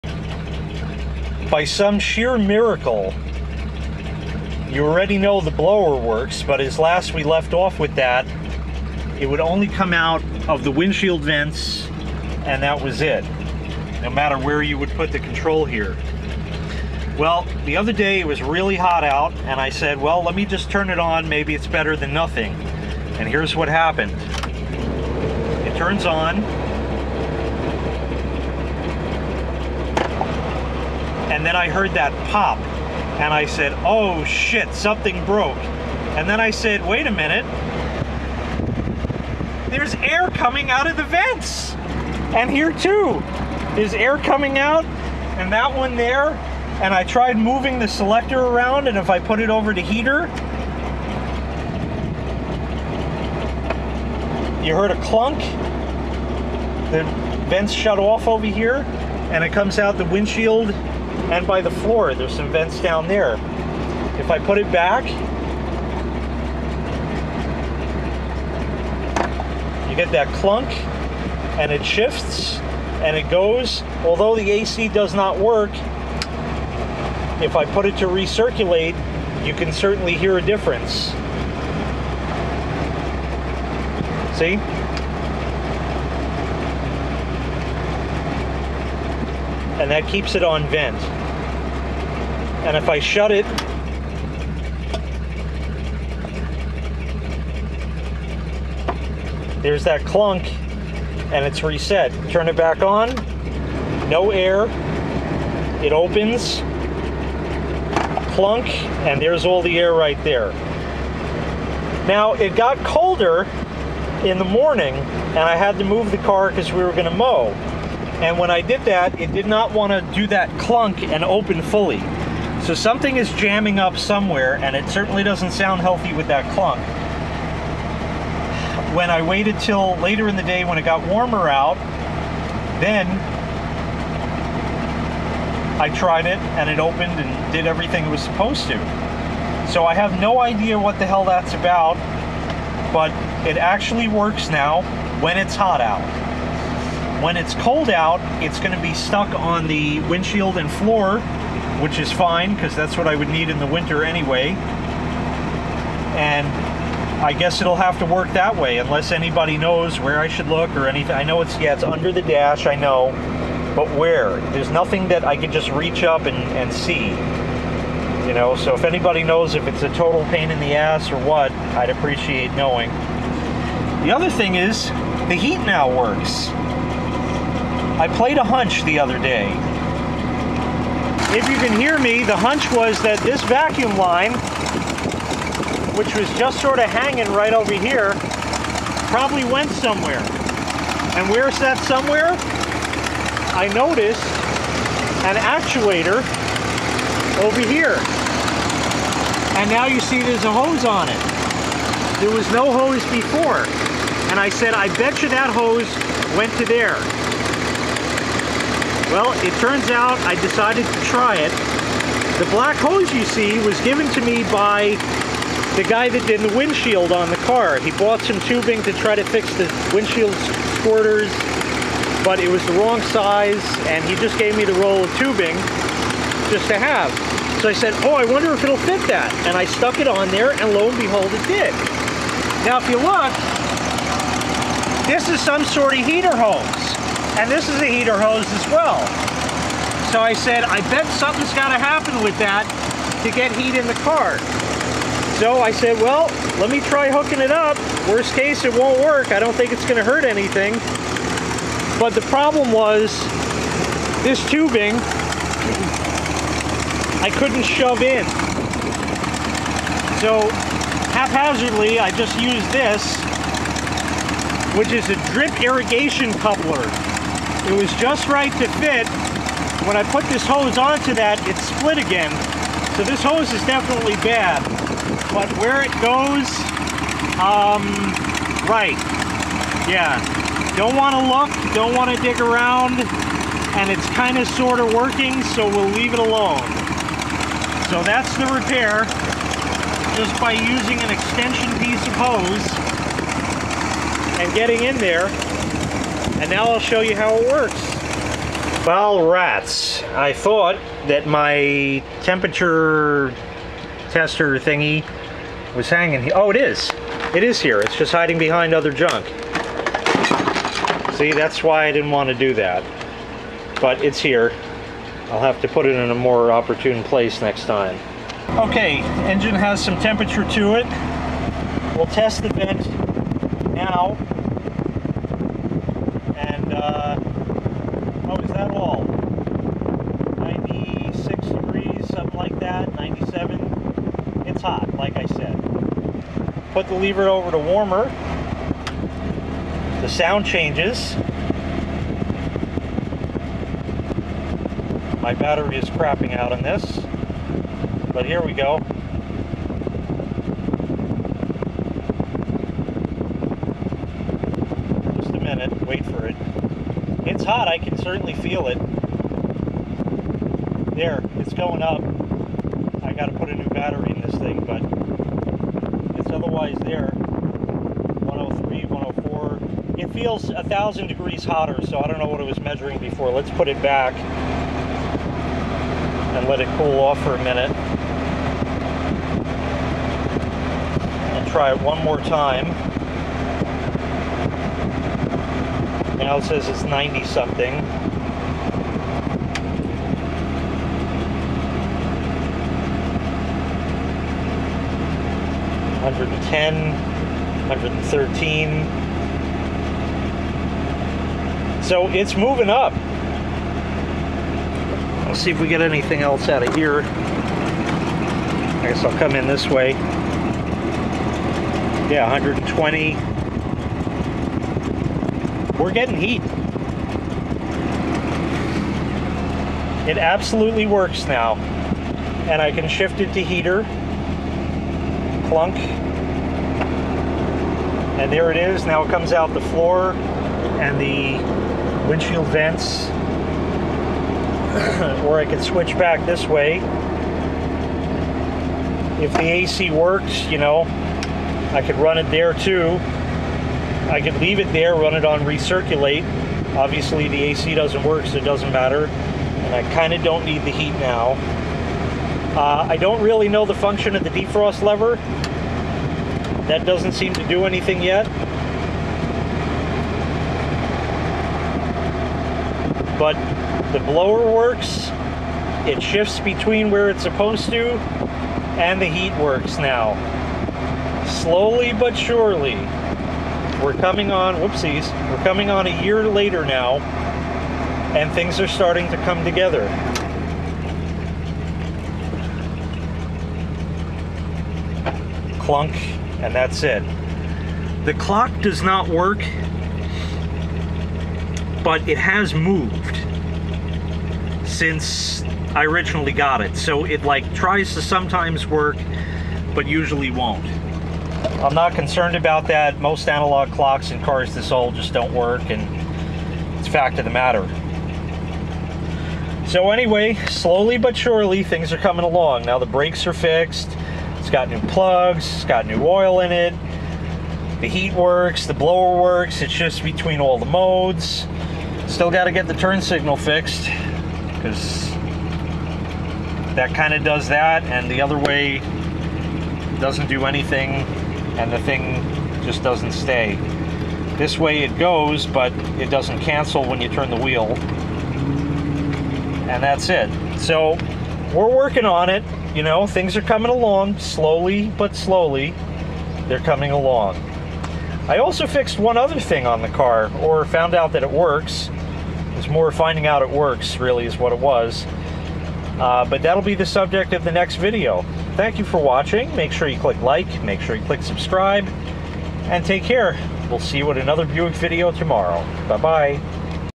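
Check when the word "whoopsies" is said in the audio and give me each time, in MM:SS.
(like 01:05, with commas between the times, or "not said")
07:54.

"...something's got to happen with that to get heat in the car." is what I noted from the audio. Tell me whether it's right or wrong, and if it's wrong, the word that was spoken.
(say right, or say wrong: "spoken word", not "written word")
right.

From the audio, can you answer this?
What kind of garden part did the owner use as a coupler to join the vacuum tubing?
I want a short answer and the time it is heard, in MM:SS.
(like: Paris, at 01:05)
drip irrigation coupler, at 04:25.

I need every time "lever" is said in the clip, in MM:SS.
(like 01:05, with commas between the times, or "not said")
05:36, 07:34.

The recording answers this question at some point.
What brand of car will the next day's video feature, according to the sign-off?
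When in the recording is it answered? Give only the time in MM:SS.
09:24.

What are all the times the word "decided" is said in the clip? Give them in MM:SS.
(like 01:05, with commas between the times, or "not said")
03:30.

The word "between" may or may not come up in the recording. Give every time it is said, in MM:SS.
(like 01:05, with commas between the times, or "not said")
07:46, 08:40.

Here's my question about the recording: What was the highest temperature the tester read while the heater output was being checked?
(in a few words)
120.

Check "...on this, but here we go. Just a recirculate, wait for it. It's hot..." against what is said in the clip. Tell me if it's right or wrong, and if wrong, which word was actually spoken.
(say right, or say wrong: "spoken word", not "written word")
wrong: "minute", not "recirculate".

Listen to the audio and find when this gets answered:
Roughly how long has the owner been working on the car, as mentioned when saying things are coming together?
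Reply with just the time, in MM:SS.
07:55.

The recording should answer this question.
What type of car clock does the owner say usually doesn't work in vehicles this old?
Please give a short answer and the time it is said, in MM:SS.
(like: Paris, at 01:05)
analog clocks, at 08:23.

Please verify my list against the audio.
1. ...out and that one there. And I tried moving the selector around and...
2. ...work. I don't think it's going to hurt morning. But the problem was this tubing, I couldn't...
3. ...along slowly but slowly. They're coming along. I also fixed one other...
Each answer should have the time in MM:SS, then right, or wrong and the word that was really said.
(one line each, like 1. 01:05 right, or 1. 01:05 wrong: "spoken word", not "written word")
1. 00:44 right
2. 04:08 wrong: "anything", not "morning"
3. 09:03 right.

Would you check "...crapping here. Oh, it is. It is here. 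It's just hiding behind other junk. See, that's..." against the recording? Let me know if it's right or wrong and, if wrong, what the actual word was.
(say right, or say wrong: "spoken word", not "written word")
wrong: "hanging", not "crapping".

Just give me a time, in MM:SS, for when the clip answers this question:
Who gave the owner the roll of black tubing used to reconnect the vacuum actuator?
03:35.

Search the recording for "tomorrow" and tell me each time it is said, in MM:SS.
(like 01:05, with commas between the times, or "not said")
09:25.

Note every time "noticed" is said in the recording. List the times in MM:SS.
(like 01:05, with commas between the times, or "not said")
03:13.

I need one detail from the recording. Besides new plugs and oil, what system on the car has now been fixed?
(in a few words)
brakes.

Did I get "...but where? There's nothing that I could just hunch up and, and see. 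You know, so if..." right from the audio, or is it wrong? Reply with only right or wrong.
wrong.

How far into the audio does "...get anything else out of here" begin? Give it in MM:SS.
06:45.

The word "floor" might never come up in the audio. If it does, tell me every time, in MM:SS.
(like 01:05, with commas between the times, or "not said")
01:01, 02:30, 07:09.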